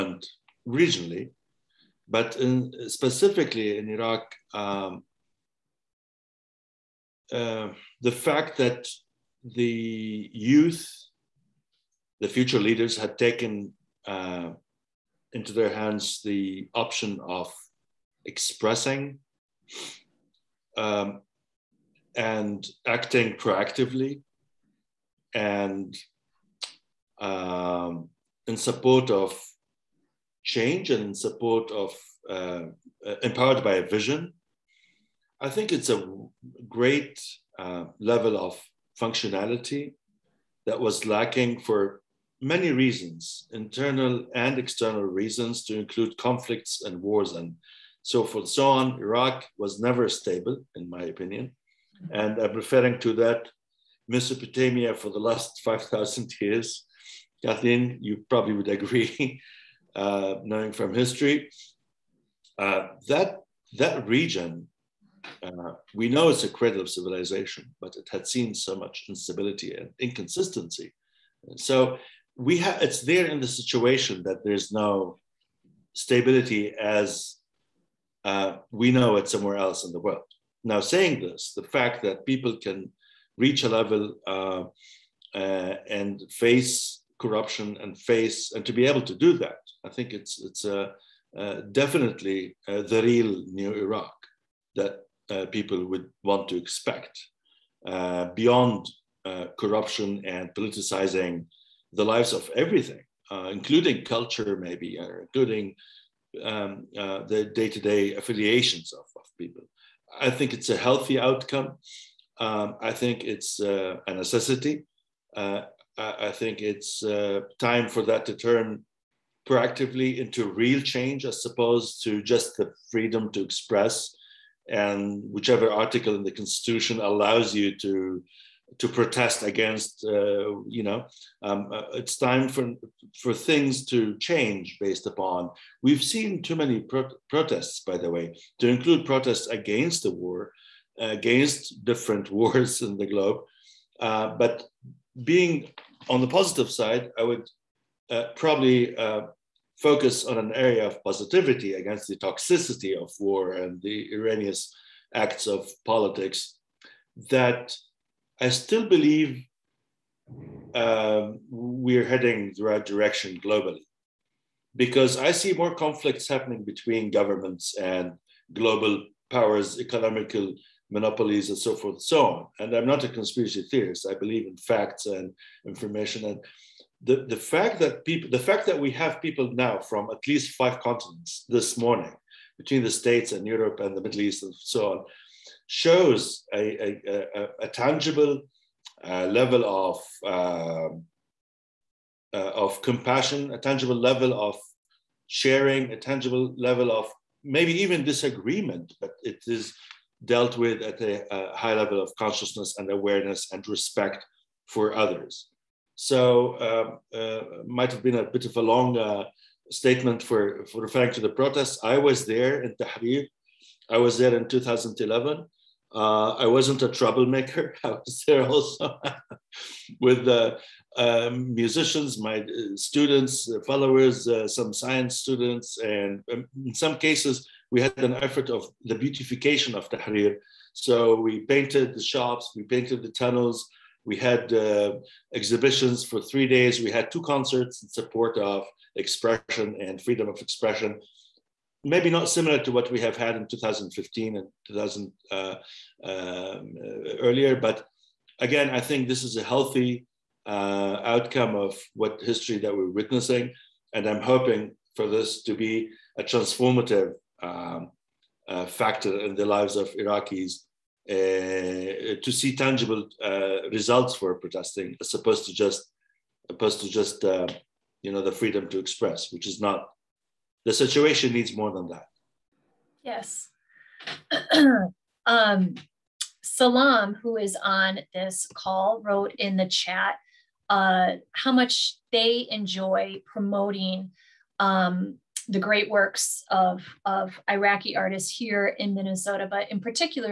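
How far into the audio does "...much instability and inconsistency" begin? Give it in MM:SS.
01:08.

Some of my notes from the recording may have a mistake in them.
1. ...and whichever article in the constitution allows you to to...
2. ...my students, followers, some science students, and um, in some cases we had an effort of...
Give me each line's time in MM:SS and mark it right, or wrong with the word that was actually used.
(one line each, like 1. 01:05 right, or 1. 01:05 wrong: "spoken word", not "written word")
1. 02:04 right
2. 03:42 right.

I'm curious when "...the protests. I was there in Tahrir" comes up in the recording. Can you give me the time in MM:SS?
03:31.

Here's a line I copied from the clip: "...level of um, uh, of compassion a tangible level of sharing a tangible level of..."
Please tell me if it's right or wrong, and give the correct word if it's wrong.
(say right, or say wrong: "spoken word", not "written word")
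right.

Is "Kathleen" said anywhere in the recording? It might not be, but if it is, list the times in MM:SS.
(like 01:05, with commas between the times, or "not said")
00:57.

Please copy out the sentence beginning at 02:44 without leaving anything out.
Because I see more conflicts happening between governments and global powers, economical monopolies, and so forth and so on.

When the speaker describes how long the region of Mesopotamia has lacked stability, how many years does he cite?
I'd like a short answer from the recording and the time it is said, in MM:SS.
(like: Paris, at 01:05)
5,000 years, at 00:55.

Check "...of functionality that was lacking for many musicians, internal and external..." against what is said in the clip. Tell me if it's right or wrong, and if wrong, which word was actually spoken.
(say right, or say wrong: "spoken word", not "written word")
wrong: "reasons", not "musicians".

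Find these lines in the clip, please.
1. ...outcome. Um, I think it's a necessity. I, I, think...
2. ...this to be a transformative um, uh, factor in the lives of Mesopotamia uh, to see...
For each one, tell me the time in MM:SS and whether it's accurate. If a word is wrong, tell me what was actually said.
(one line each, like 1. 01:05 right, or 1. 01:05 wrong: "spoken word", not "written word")
1. 01:51 right
2. 04:15 wrong: "Iraqis", not "Mesopotamia".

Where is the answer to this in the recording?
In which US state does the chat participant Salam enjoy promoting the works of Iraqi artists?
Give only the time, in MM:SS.
04:48.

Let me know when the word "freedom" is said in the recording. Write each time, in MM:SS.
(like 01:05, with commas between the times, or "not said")
02:02, 04:00, 04:28.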